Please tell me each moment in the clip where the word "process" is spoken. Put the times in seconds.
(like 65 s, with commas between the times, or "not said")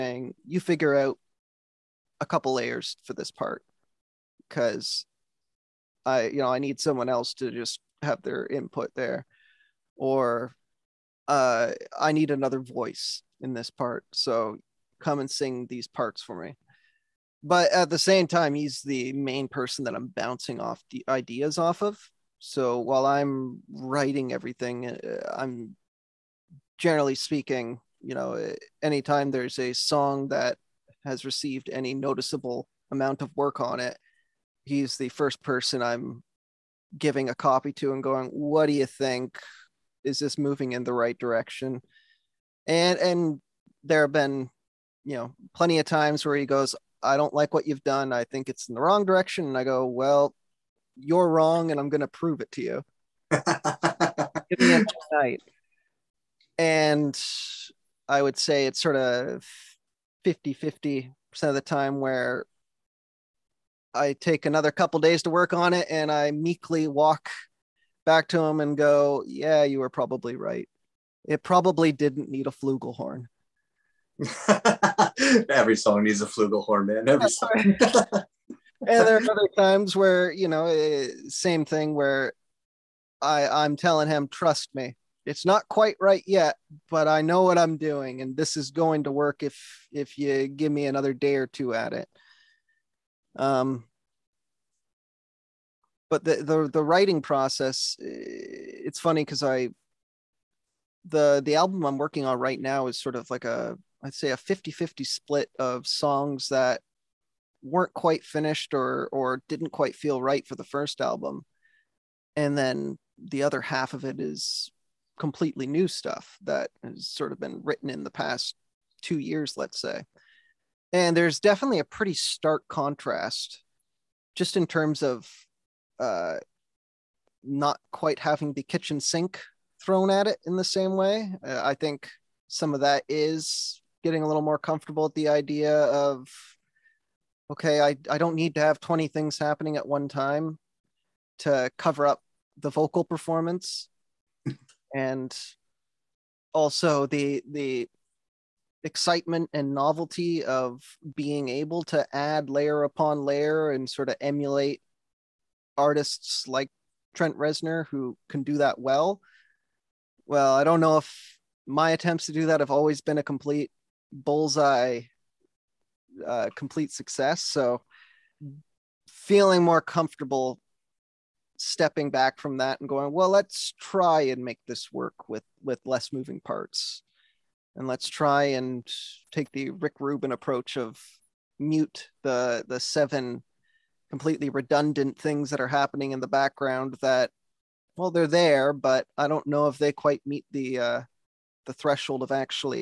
97 s.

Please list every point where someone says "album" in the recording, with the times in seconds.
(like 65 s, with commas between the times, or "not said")
101 s, 111 s.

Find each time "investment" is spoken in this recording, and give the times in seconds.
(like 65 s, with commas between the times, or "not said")
not said.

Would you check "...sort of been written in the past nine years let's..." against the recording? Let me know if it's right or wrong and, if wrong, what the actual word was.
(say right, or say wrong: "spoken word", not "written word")
wrong: "two", not "nine".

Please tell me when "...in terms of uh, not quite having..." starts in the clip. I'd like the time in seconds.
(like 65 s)
124 s.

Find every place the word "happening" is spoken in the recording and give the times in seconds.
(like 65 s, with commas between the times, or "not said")
139 s, 185 s.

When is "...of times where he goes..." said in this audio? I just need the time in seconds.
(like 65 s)
45 s.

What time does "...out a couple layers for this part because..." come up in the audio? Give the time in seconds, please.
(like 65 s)
0 s.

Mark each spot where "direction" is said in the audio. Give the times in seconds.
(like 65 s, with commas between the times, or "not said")
41 s, 49 s.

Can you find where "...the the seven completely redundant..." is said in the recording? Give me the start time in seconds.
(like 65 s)
182 s.